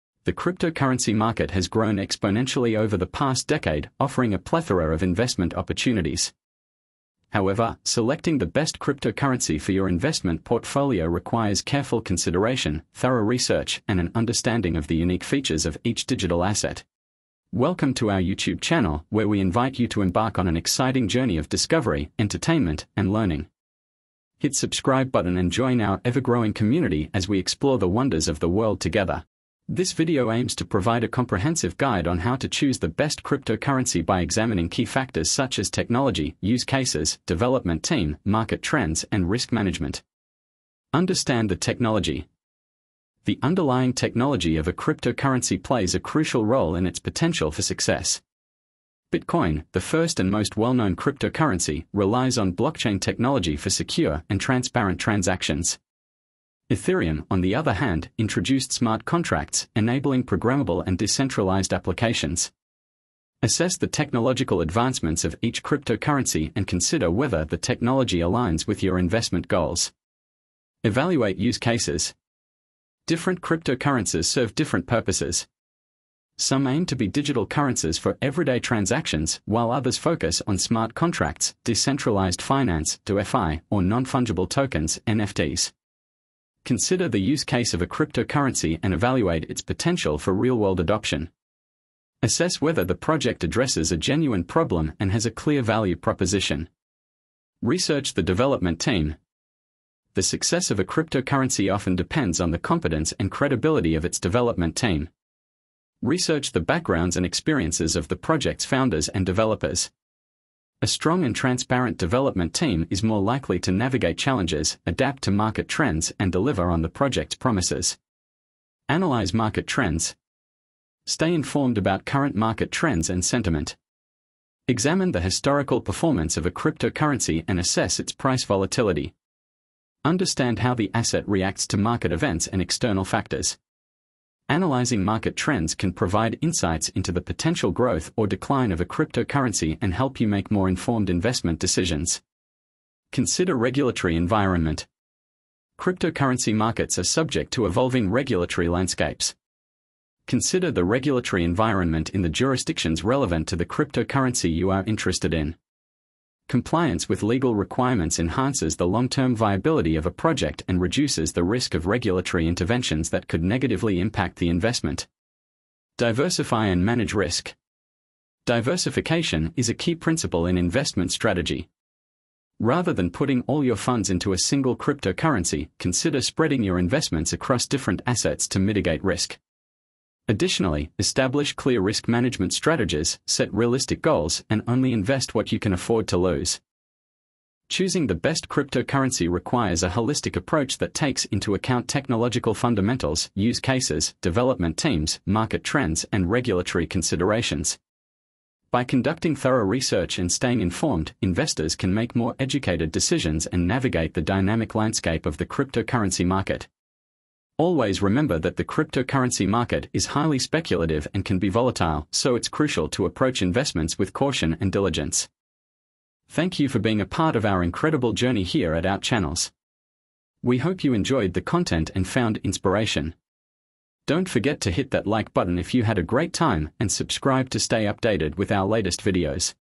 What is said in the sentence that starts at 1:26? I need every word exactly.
Consider the use case of a cryptocurrency and evaluate its potential for real-world adoption.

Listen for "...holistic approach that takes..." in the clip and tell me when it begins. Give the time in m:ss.
3:09.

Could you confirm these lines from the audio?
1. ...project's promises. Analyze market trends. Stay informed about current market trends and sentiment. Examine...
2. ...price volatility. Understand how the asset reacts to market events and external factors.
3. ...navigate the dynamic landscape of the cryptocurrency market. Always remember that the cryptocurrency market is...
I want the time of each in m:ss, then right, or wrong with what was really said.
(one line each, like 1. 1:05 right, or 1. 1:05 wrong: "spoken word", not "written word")
1. 1:56 right
2. 2:08 right
3. 3:23 right.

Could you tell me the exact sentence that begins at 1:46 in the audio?
Research the backgrounds and experiences of the project's founders and developers.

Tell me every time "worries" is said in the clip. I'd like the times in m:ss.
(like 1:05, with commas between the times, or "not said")
not said.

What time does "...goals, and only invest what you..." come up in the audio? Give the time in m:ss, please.
3:04.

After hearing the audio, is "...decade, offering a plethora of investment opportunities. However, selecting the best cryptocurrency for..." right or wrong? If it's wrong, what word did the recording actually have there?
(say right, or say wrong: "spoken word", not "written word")
right.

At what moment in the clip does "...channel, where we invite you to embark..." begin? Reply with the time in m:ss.
0:18.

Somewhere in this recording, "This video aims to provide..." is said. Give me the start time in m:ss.
0:29.